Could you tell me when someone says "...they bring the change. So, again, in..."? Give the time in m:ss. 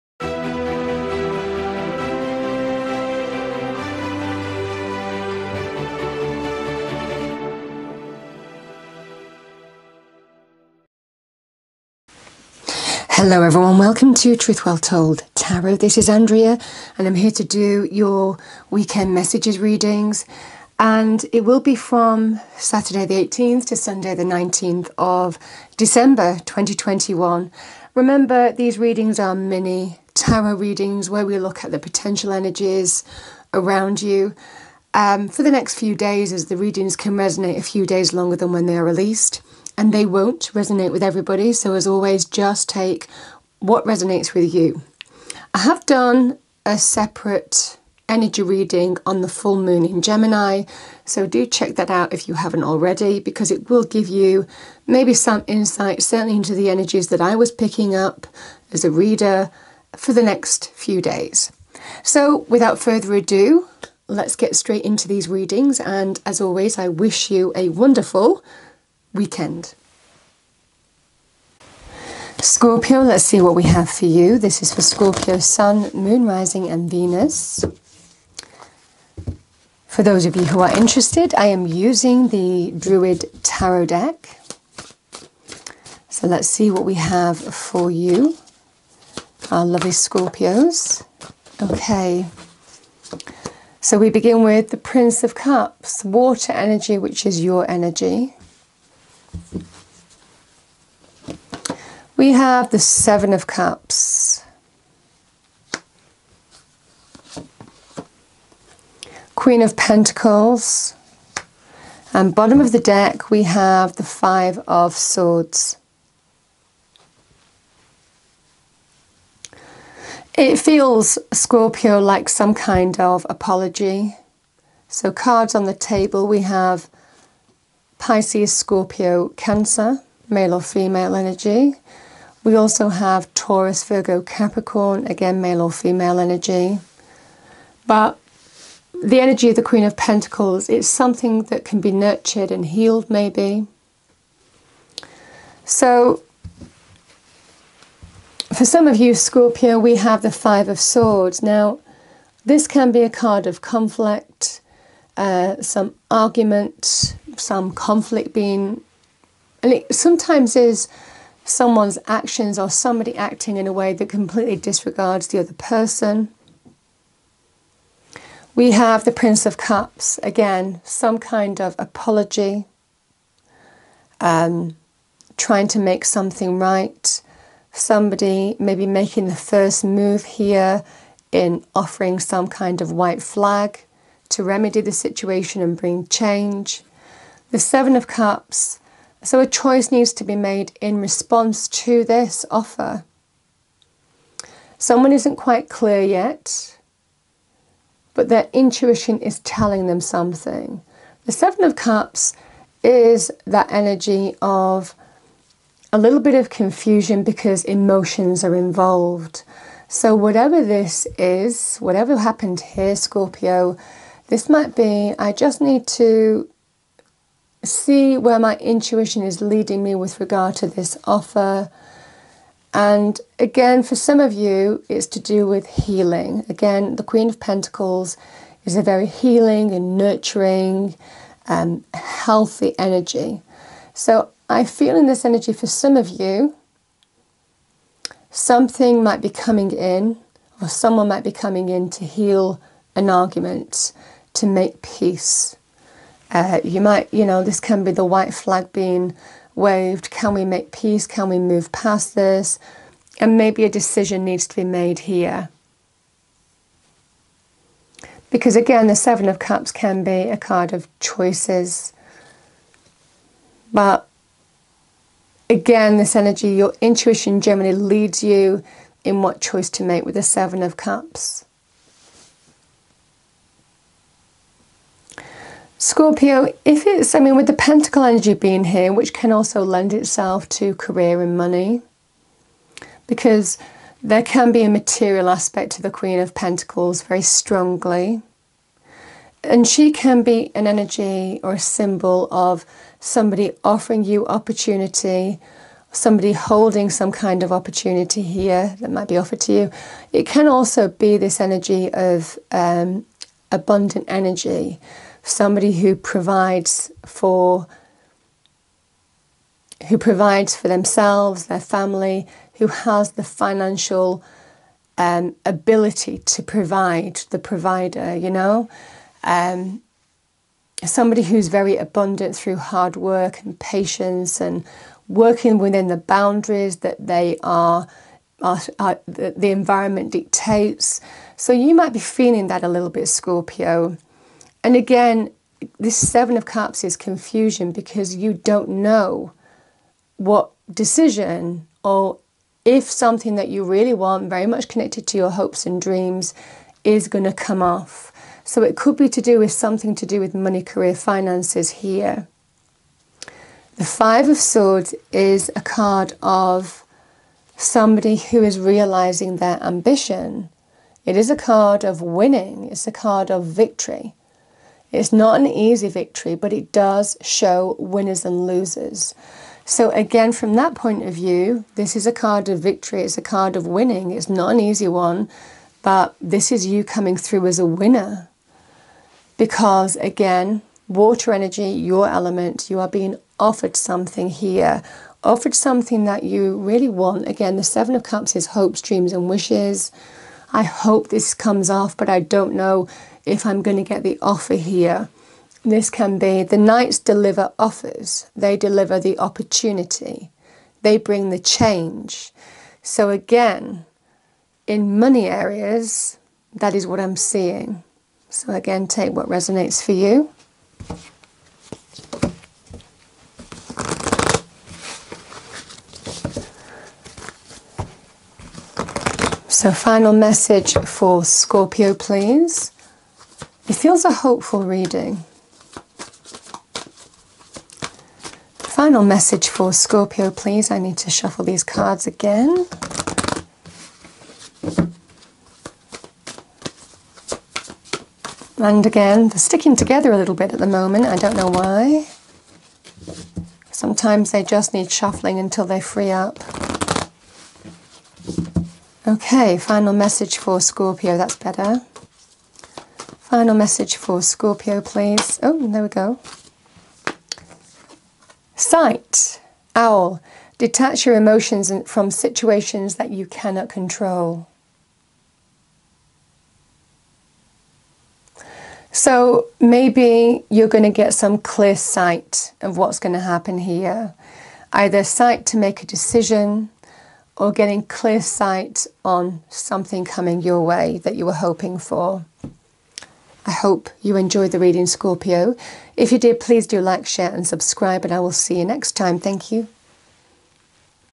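6:40.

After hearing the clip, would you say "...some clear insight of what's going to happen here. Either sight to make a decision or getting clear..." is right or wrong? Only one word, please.
wrong.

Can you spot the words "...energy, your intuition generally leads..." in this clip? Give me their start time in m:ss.
4:26.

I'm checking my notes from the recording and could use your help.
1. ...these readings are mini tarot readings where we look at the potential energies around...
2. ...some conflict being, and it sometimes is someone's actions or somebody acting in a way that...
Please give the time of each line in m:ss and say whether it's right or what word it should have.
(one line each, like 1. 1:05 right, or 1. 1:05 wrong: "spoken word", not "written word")
1. 0:28 right
2. 2:37 right.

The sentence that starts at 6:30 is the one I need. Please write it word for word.
I hope this comes off, but I don't know if I'm going to get the offer here.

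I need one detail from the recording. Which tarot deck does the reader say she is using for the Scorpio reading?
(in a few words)
Druid Tarot deck.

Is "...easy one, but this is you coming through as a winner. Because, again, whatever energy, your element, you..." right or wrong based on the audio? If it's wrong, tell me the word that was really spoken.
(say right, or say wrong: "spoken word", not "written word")
wrong: "water", not "whatever".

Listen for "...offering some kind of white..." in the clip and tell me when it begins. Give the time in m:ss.
3:01.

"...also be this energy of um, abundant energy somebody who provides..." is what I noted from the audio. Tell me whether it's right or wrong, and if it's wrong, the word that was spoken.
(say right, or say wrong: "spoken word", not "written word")
right.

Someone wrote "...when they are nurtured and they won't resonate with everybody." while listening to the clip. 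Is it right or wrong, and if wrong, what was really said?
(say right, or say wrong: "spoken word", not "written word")
wrong: "released", not "nurtured".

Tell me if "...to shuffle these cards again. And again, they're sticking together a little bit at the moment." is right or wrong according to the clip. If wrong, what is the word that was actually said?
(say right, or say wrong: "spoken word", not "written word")
right.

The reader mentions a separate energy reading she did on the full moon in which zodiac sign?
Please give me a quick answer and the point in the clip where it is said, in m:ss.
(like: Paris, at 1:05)
Gemini, at 0:50.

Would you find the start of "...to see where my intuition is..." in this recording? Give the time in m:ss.
3:35.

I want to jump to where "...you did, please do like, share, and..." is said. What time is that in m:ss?
8:06.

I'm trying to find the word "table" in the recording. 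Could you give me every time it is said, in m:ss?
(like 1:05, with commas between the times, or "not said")
2:05.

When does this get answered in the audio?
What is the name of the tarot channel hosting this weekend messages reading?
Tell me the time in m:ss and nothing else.
0:14.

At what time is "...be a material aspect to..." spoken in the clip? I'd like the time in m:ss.
4:44.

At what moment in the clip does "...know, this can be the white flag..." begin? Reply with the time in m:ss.
4:07.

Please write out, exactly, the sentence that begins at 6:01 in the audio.
It is a card of winning, it's a card of victory.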